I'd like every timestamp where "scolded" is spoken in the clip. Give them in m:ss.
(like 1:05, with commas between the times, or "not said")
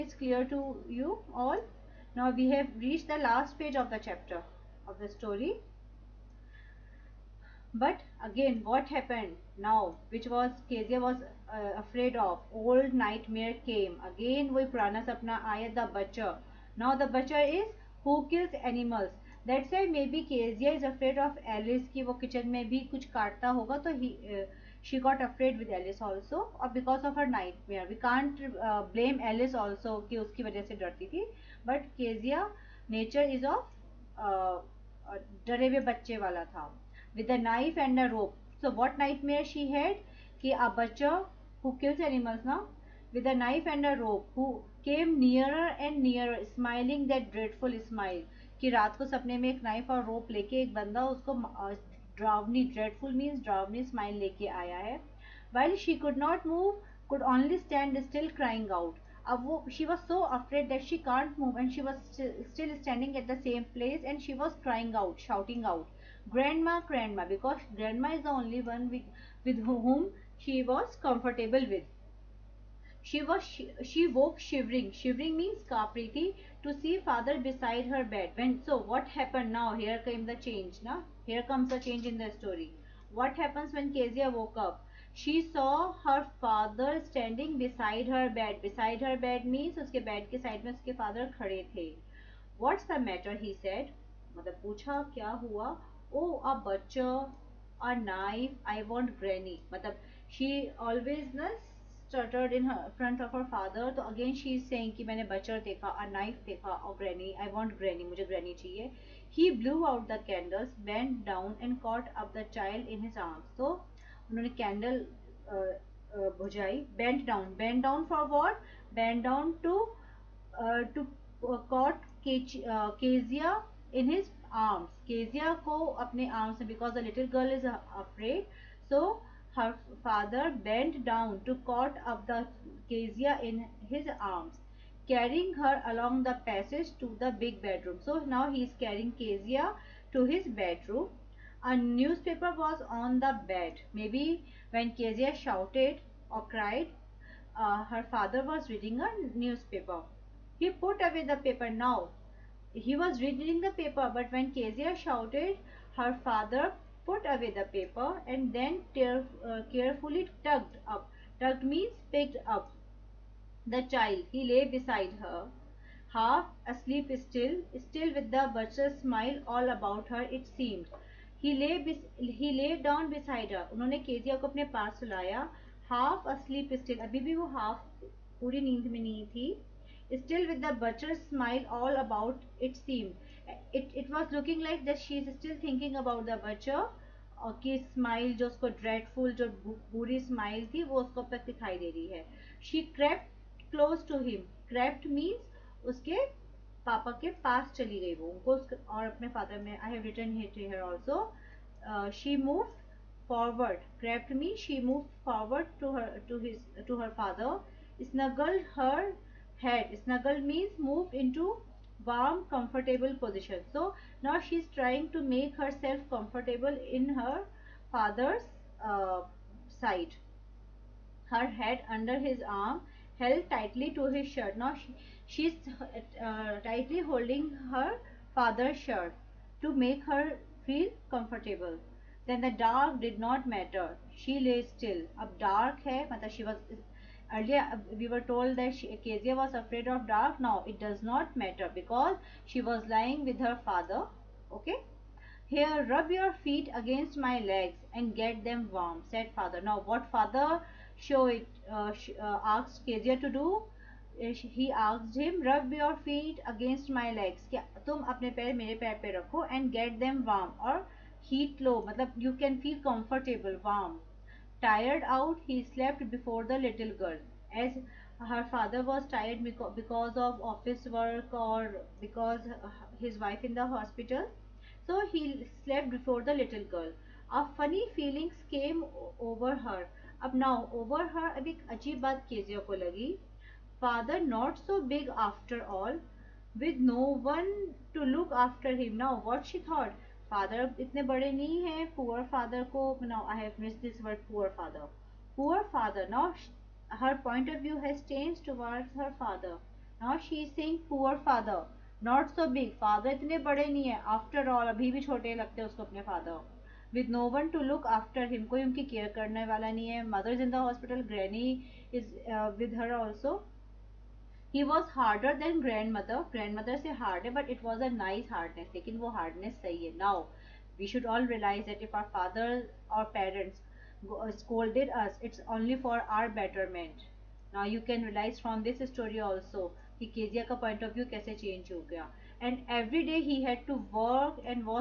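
5:24.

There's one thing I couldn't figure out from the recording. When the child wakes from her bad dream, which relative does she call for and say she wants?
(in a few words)
Granny.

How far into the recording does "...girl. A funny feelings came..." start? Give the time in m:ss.
4:36.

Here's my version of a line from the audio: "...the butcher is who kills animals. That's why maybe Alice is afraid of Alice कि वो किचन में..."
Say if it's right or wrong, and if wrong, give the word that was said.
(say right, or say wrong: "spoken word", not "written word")
wrong: "Kezia", not "Alice".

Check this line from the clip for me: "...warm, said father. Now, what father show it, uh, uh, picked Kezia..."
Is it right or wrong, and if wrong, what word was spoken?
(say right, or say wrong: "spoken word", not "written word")
wrong: "asked", not "picked".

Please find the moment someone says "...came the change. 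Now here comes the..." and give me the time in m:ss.
1:20.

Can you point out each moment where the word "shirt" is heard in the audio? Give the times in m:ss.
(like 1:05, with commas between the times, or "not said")
3:44, 3:48.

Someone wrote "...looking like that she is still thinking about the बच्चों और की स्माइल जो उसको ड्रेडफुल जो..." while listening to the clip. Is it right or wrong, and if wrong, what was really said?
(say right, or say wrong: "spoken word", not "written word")
right.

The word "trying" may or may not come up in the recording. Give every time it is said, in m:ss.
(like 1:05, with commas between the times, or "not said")
3:34.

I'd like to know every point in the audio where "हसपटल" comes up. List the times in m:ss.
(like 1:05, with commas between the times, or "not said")
5:10.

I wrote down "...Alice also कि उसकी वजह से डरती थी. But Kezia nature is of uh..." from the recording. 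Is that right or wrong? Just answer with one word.
right.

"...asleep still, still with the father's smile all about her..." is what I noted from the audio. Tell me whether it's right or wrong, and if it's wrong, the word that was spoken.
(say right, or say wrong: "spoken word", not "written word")
wrong: "butcher", not "father".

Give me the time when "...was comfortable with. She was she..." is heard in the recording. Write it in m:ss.
1:10.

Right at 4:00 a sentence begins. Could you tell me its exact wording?
Now it does not matter because she was lying with her father.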